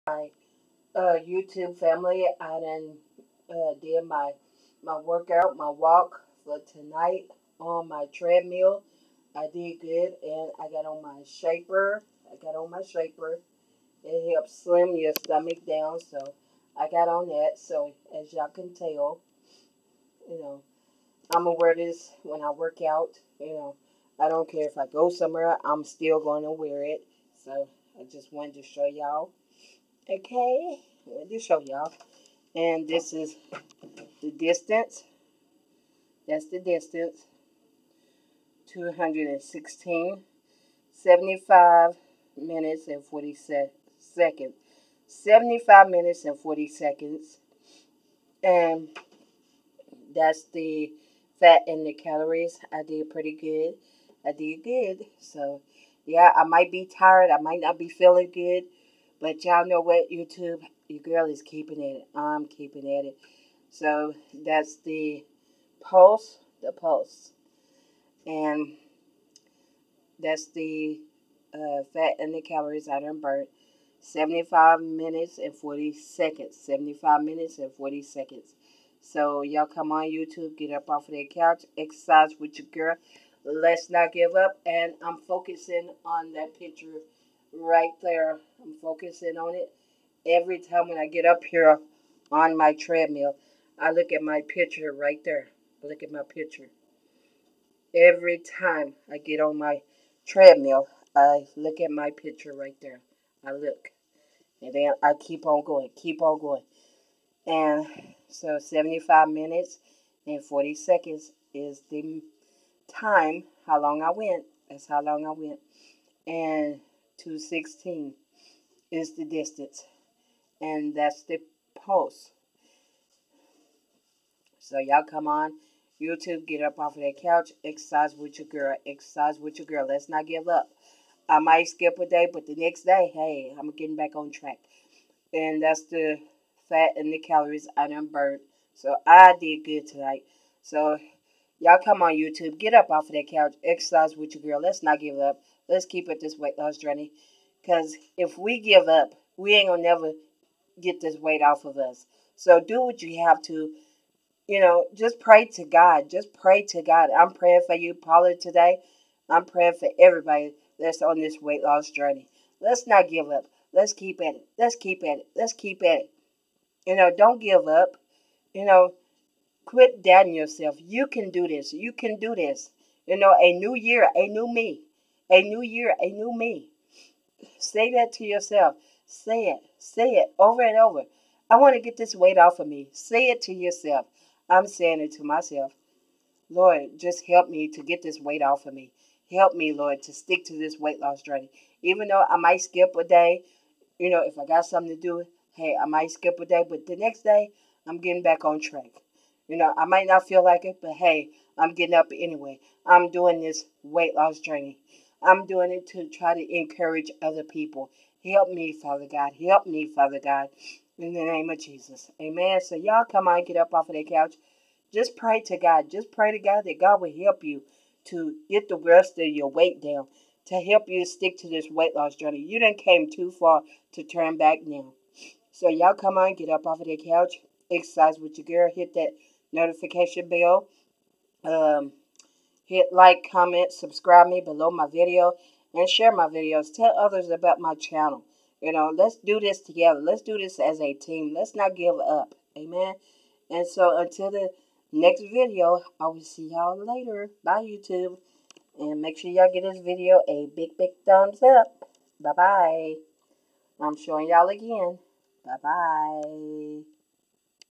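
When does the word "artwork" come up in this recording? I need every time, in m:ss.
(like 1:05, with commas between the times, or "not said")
not said.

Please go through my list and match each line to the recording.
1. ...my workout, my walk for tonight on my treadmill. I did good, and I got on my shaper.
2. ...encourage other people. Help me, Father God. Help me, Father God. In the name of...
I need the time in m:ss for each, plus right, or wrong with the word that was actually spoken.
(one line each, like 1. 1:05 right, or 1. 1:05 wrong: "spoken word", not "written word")
1. 0:04 right
2. 3:26 right.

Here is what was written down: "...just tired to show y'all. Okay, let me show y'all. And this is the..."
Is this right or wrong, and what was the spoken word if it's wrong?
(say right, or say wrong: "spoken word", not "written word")
wrong: "wanted", not "tired".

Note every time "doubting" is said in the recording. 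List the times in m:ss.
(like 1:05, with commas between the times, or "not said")
2:50.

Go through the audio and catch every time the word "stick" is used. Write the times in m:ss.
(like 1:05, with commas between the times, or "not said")
3:10, 3:41.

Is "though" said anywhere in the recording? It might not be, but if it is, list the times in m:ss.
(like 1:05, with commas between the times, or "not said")
3:12.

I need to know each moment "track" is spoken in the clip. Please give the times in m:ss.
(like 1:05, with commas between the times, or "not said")
2:14, 3:18.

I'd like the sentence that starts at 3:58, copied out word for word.
You know, let's do this together.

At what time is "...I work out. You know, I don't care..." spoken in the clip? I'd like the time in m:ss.
0:22.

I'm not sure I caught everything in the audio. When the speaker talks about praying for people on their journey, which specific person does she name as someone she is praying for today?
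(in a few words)
Paula.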